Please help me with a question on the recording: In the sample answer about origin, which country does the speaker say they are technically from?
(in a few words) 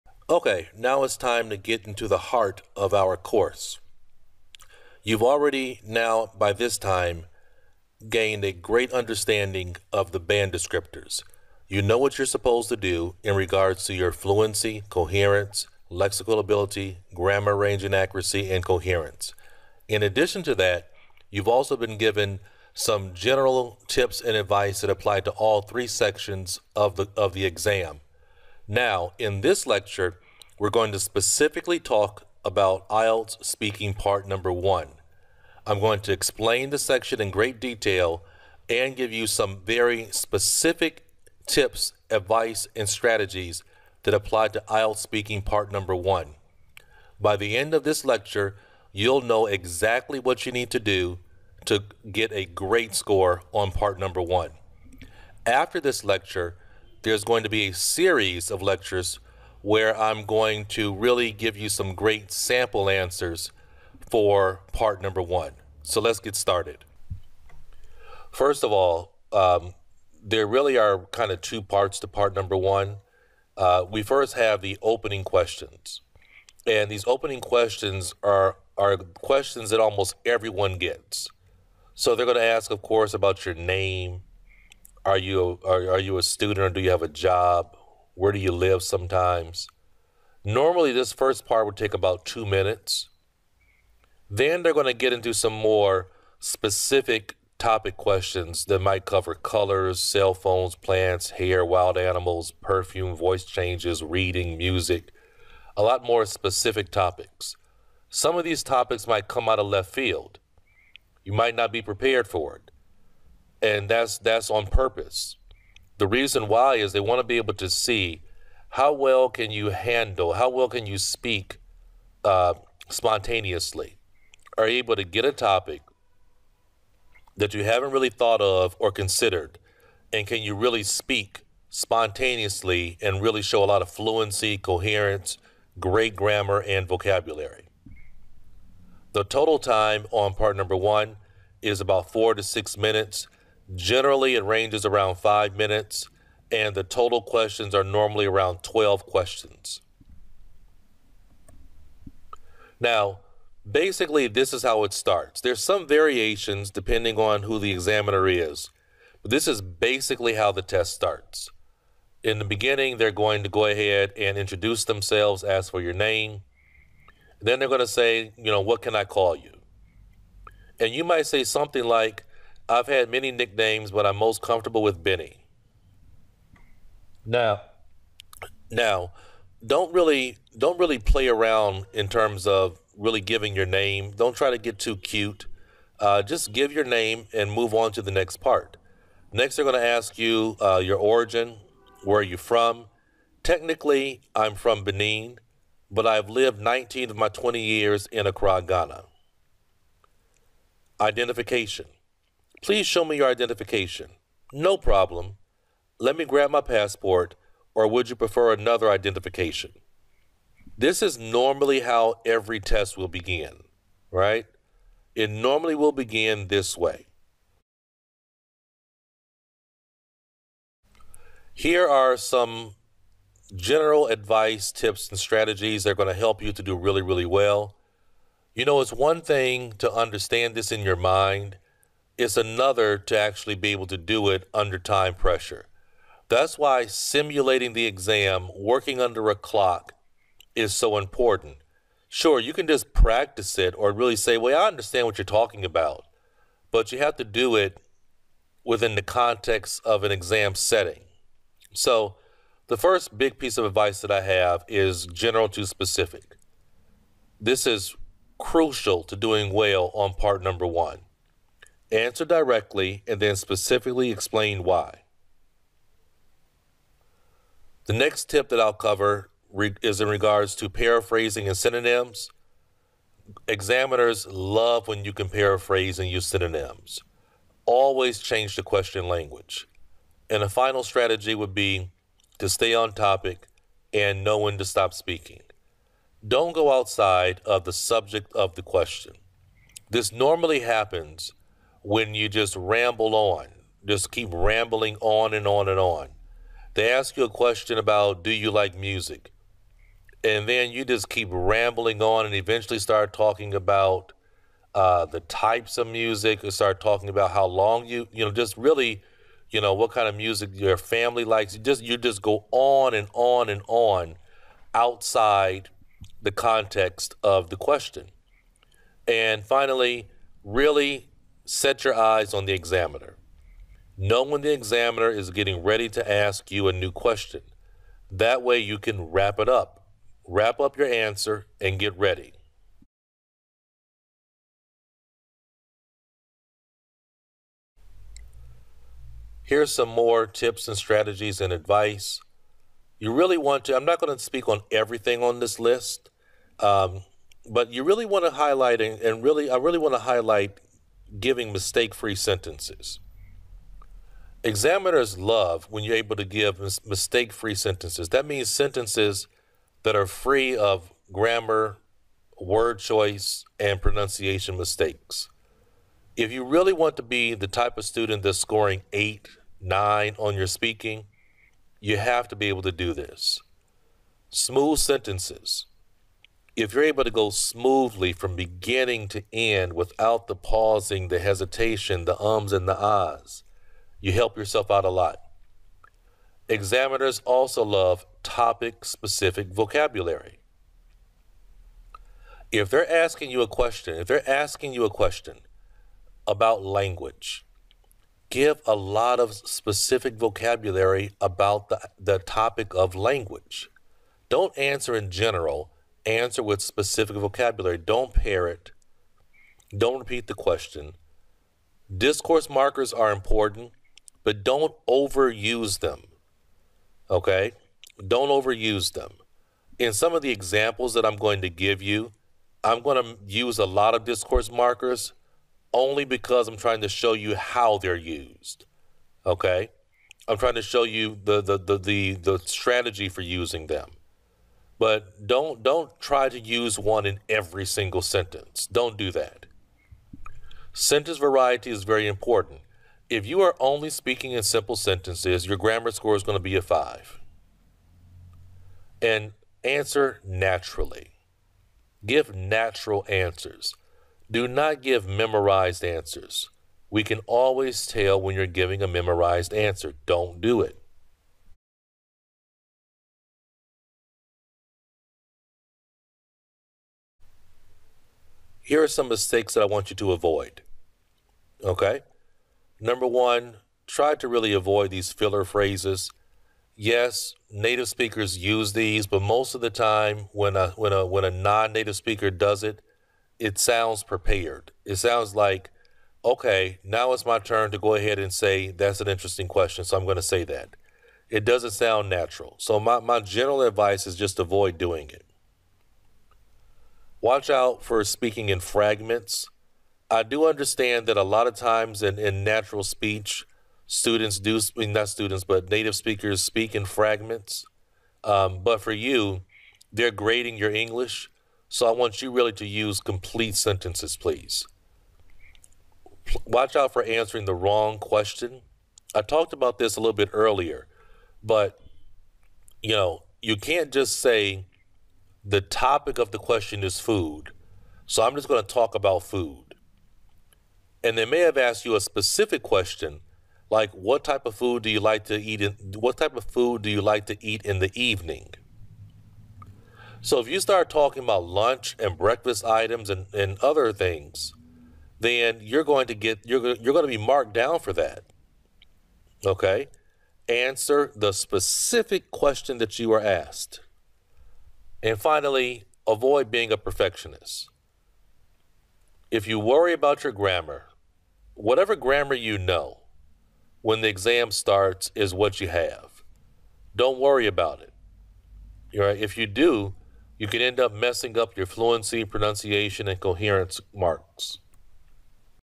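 Benin.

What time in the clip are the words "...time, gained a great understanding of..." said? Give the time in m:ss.
0:06.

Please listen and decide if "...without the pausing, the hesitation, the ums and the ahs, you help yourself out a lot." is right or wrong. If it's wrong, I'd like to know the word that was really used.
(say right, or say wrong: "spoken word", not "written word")
right.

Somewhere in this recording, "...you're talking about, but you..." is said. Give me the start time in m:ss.
4:05.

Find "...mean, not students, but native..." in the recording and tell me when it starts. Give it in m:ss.
8:24.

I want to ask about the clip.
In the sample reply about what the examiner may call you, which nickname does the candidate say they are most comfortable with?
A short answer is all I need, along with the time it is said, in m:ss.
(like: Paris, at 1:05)
Benny, at 2:55.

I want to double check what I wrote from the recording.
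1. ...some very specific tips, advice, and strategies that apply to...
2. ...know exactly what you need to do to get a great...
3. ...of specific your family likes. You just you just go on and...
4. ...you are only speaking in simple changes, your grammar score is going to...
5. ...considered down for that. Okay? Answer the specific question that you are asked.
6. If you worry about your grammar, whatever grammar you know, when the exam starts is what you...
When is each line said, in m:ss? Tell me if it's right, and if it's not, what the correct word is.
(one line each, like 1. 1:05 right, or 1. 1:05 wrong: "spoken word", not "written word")
1. 0:39 right
2. 0:49 right
3. 5:10 wrong: "music", not "specific"
4. 7:23 wrong: "sentences", not "changes"
5. 9:07 wrong: "marked", not "considered"
6. 9:19 right.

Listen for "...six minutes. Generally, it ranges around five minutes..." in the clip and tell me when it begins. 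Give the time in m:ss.
2:22.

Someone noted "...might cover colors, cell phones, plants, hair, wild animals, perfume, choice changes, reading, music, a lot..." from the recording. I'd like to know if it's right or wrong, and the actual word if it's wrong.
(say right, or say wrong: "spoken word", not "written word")
wrong: "voice", not "choice".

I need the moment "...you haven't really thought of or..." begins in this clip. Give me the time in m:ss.
2:07.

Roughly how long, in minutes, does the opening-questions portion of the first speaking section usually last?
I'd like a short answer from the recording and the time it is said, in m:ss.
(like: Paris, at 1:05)
2 minutes, at 1:32.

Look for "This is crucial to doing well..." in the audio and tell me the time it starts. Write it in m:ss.
4:17.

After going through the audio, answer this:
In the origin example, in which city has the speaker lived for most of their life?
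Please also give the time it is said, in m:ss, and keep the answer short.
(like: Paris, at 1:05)
Accra, Ghana, at 3:18.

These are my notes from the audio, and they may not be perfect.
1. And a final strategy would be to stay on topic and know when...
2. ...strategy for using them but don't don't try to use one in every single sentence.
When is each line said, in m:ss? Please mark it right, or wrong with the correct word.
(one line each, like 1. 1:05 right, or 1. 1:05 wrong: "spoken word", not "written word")
1. 4:40 right
2. 7:12 right.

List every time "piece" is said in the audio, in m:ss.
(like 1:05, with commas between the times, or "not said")
4:13.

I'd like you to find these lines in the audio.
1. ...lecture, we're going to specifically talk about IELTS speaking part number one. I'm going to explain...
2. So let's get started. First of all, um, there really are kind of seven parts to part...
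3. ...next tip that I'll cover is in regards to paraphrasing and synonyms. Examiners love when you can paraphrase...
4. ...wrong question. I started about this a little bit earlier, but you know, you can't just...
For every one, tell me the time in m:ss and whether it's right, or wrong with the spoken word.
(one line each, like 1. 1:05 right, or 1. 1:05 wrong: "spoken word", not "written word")
1. 0:29 right
2. 1:05 wrong: "two", not "seven"
3. 4:27 right
4. 8:37 wrong: "talked", not "started".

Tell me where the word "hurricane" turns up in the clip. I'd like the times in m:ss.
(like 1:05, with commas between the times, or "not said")
not said.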